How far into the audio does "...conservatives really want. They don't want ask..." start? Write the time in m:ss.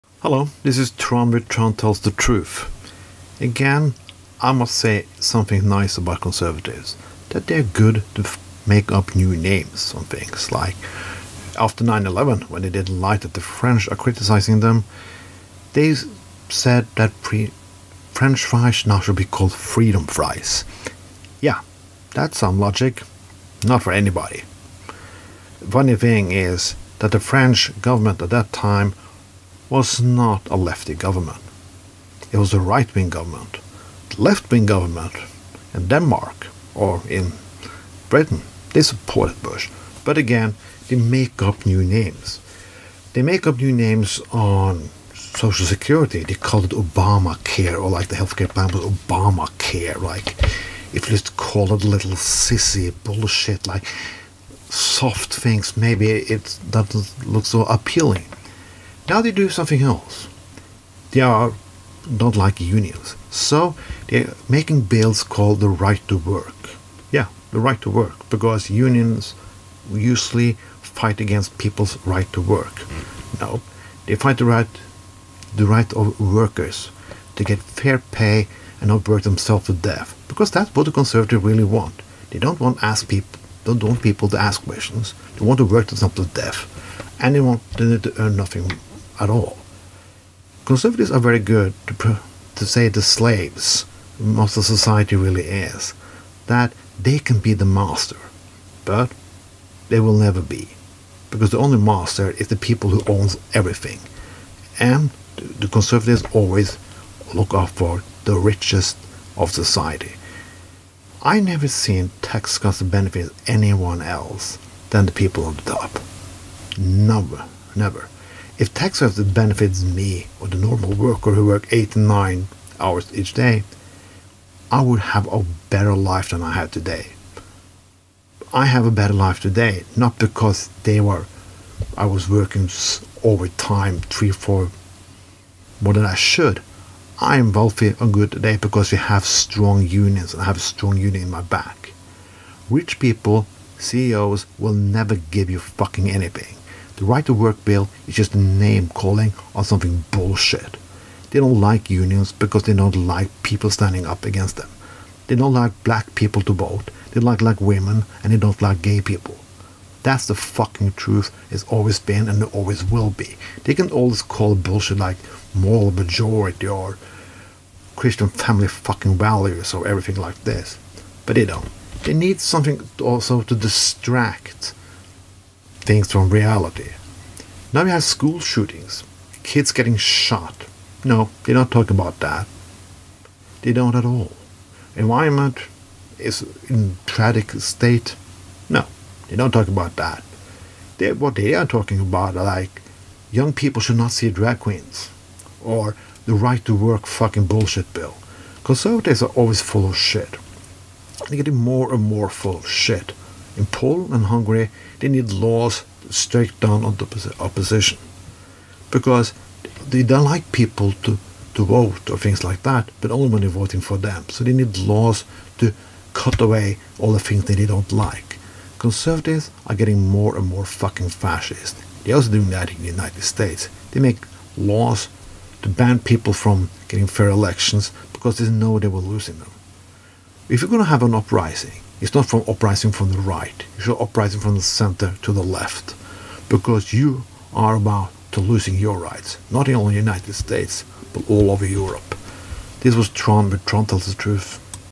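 1:20.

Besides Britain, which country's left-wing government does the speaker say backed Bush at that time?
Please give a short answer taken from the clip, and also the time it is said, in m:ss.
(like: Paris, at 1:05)
Denmark, at 0:35.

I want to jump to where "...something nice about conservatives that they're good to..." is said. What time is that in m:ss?
0:05.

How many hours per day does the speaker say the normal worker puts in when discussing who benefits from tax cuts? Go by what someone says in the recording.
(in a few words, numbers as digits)
8 to 9 hours.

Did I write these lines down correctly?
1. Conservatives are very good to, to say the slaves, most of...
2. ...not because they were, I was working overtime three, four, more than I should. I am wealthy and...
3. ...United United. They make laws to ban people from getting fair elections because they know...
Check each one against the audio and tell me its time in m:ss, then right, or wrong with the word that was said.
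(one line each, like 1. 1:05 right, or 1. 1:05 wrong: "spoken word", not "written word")
1. 1:30 right
2. 2:09 right
3. 3:42 wrong: "States", not "United".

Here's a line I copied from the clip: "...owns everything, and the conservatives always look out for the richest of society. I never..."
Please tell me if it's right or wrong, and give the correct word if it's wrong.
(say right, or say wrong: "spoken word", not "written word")
right.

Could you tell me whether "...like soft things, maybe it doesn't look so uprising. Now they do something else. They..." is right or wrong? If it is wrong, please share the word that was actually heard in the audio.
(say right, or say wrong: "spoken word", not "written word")
wrong: "appealing", not "uprising".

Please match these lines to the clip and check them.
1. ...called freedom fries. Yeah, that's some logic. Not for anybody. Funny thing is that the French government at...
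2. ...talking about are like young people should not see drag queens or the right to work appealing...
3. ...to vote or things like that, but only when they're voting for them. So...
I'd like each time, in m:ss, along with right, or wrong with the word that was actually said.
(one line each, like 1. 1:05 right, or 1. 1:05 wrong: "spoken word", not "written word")
1. 0:19 right
2. 3:11 wrong: "fucking", not "appealing"
3. 3:31 right.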